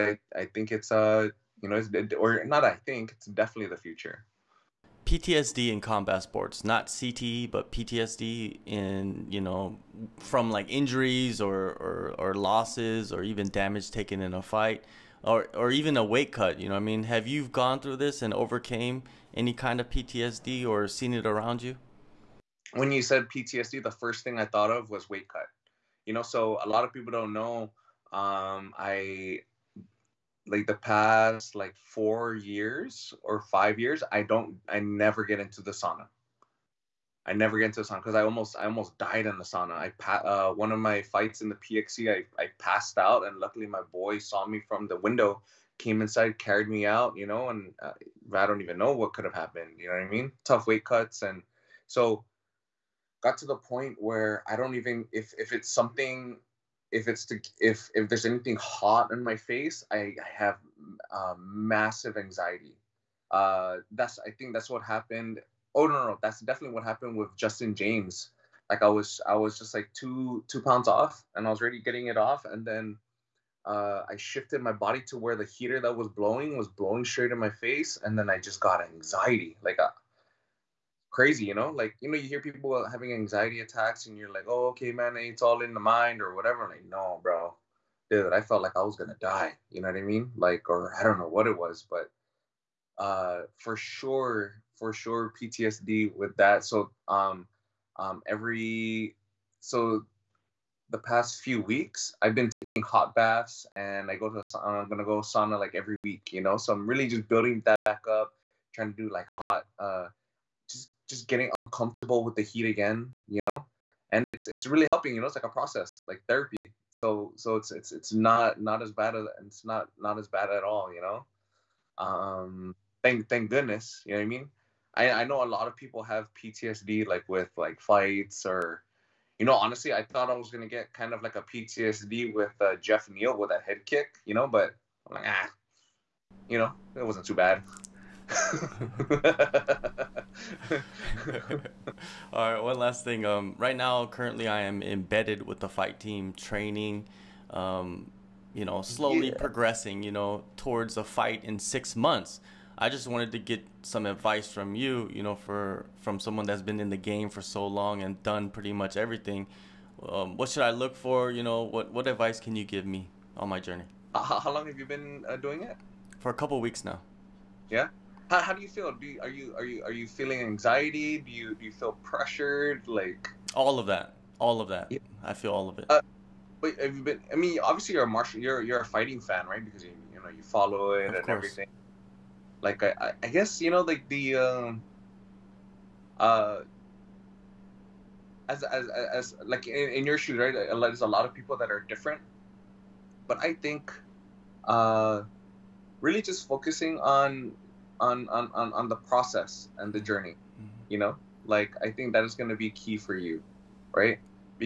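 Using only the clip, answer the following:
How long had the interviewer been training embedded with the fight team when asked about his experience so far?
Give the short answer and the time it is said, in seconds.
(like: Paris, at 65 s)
a couple weeks, at 166 s.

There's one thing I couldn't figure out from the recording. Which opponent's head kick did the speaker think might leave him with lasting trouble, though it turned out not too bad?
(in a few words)
Geoff Neal.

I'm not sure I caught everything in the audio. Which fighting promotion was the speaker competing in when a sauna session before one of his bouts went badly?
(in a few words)
PXC.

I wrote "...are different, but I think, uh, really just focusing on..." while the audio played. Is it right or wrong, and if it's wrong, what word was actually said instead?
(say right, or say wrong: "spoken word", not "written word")
right.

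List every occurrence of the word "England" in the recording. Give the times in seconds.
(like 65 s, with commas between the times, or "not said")
not said.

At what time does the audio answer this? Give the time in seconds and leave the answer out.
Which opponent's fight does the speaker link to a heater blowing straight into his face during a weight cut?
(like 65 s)
67 s.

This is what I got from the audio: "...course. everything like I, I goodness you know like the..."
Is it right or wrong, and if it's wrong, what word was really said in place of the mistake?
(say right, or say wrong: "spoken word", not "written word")
wrong: "guess", not "goodness".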